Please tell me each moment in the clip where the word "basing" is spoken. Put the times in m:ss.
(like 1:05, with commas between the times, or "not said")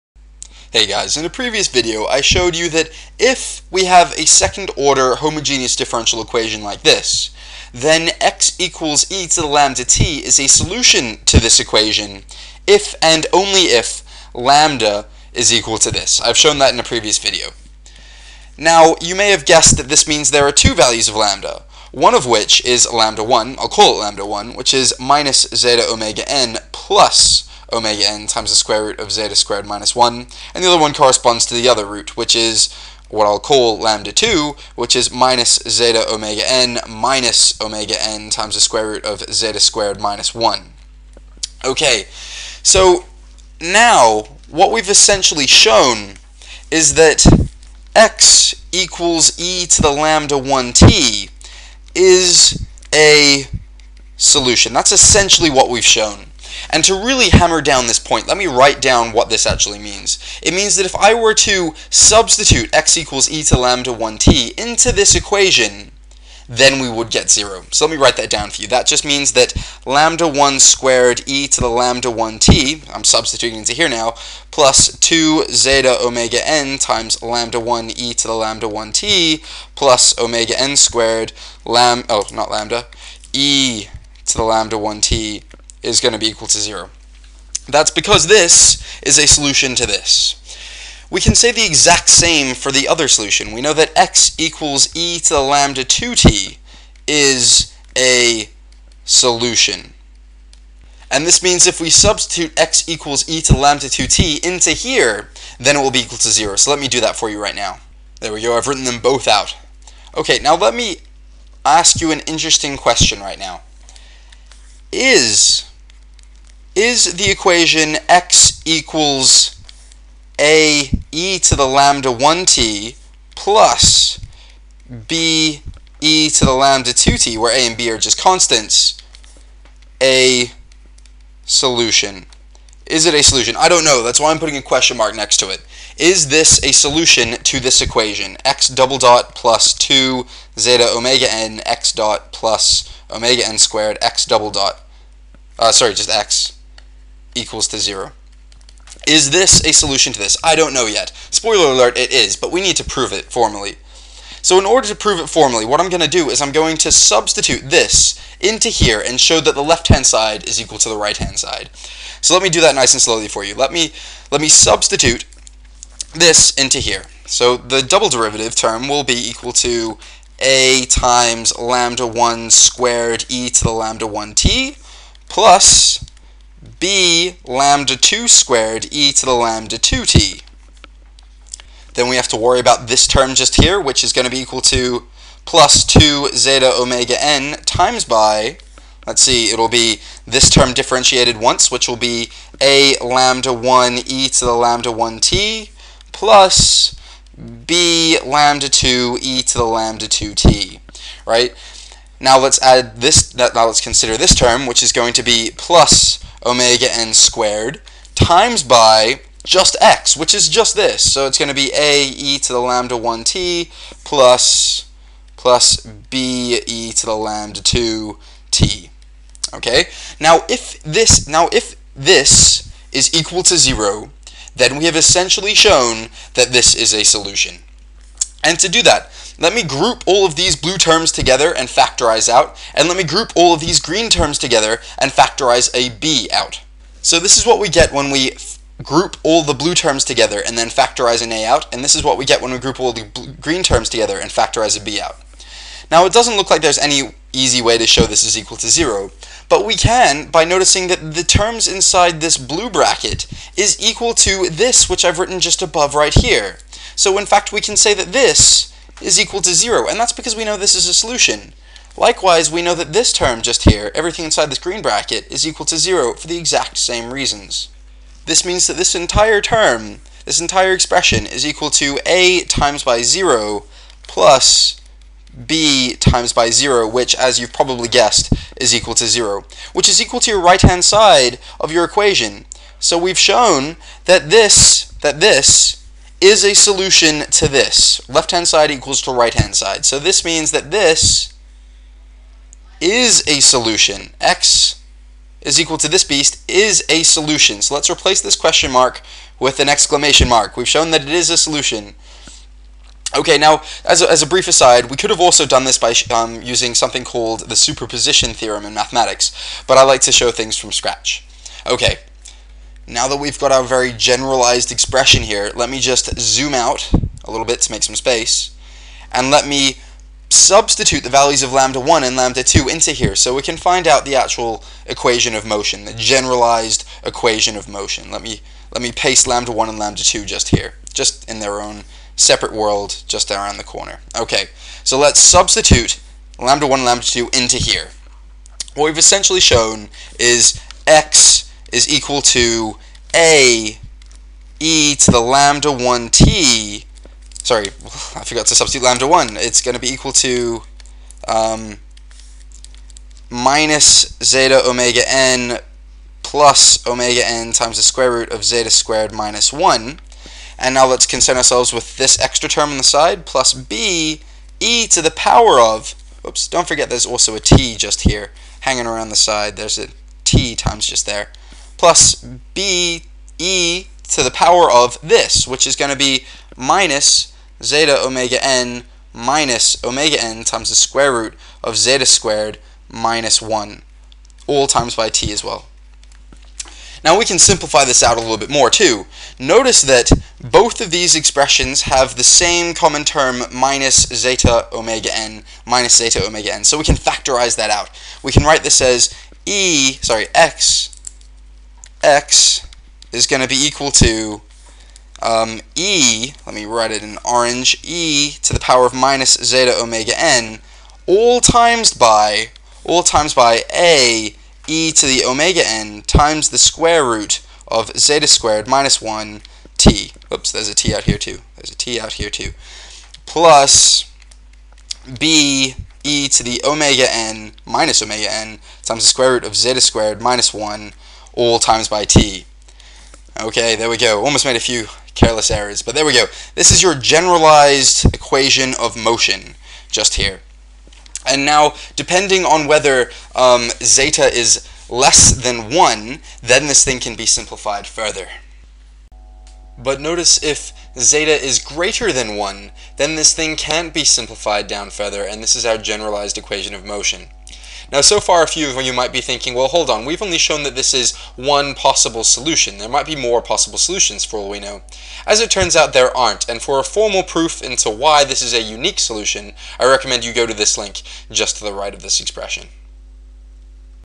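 not said.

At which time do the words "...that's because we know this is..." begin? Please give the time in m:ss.
4:19.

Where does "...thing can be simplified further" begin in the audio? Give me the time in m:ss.
7:26.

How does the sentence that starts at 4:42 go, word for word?
So we've shown that this, that this, is a solution to this.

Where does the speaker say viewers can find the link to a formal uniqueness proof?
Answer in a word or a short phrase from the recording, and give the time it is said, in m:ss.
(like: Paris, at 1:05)
to the right, at 7:51.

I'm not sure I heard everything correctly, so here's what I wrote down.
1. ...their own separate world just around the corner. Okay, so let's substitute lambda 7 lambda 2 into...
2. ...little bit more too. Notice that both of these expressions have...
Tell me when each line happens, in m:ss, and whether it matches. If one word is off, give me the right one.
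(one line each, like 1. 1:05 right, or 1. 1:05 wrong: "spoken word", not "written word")
1. 5:31 wrong: "1", not "7"
2. 6:28 right.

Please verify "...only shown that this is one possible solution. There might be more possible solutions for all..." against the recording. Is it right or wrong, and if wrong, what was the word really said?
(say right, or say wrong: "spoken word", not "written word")
right.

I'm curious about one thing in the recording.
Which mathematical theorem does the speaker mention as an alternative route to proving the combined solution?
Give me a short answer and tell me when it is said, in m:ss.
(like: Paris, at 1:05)
superposition theorem, at 5:07.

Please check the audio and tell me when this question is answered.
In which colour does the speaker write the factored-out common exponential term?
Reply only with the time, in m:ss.
6:47.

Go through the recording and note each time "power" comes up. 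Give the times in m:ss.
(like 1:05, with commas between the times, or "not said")
6:05, 6:14, 6:48.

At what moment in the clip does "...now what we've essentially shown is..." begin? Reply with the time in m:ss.
0:43.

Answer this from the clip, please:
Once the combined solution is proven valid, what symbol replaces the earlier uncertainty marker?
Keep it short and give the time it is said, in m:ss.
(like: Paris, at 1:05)
exclamation mark, at 4:59.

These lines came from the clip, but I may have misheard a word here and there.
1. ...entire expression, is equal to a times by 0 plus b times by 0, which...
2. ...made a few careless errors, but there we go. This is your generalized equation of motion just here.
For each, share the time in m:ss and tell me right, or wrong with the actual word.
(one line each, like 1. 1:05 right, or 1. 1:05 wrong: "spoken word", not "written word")
1. 4:30 right
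2. 7:14 right.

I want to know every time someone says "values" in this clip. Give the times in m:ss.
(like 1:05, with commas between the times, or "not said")
0:20, 5:21.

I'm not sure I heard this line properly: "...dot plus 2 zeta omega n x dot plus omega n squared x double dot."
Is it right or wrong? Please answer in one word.
right.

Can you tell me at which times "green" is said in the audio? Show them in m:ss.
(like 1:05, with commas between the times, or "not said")
3:53, 4:03, 4:24.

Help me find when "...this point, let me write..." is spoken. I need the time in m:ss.
0:57.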